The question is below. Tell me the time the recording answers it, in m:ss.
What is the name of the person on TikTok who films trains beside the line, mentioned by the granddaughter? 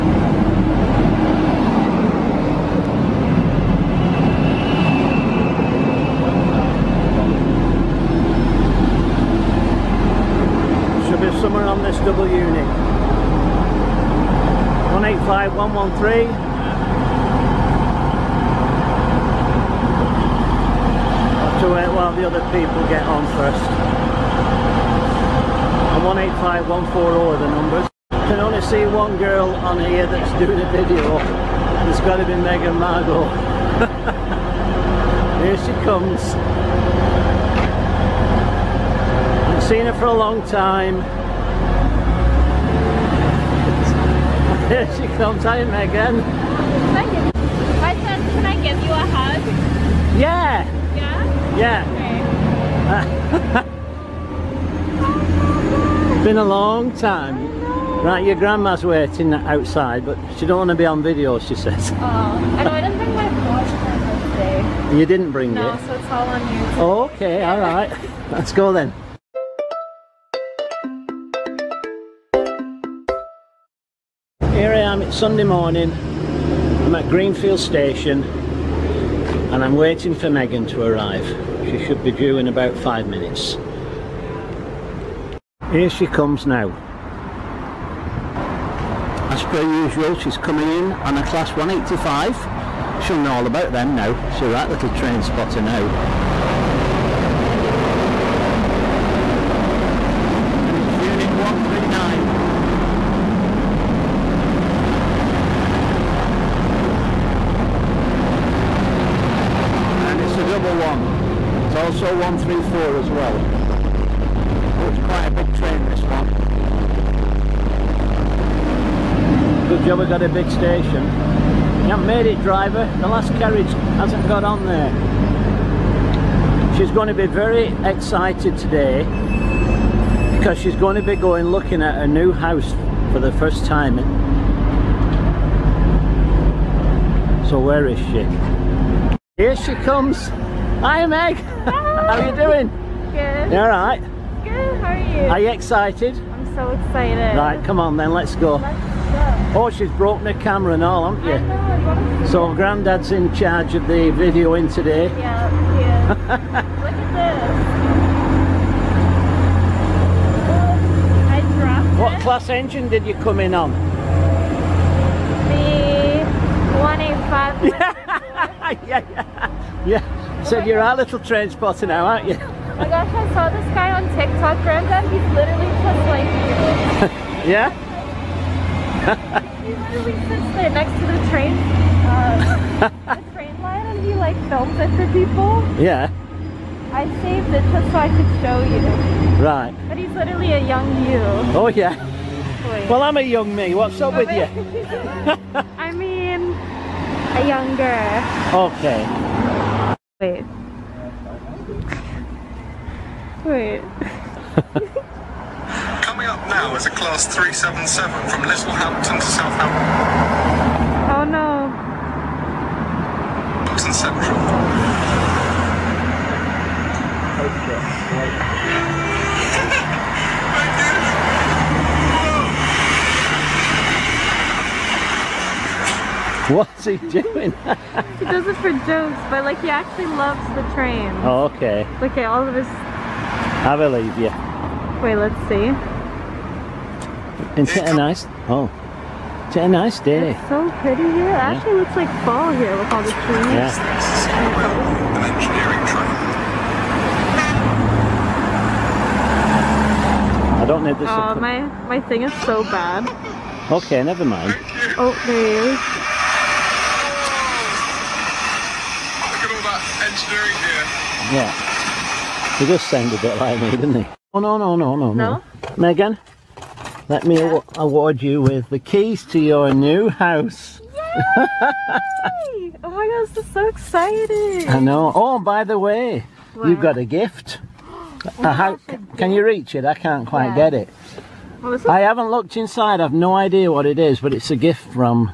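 2:54.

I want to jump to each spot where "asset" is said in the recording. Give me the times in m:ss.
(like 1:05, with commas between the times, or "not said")
not said.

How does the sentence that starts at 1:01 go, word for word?
Oh, I know, I didn't bring my watch today.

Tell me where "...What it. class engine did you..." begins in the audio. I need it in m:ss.
2:41.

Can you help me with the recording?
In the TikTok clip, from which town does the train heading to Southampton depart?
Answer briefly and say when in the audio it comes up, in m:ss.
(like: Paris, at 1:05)
Littlehampton, at 3:28.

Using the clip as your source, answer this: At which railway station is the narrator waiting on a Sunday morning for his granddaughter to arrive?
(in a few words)
Greenfield.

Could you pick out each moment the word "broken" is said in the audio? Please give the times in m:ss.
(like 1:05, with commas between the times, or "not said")
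2:29.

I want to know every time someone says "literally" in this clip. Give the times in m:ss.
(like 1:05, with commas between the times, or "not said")
2:55, 2:59, 3:10.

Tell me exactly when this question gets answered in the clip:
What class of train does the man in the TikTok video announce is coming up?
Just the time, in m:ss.
3:27.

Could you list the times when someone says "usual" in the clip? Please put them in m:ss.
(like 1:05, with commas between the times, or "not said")
1:29.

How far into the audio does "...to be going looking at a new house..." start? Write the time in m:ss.
2:10.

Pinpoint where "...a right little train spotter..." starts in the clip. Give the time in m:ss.
1:34.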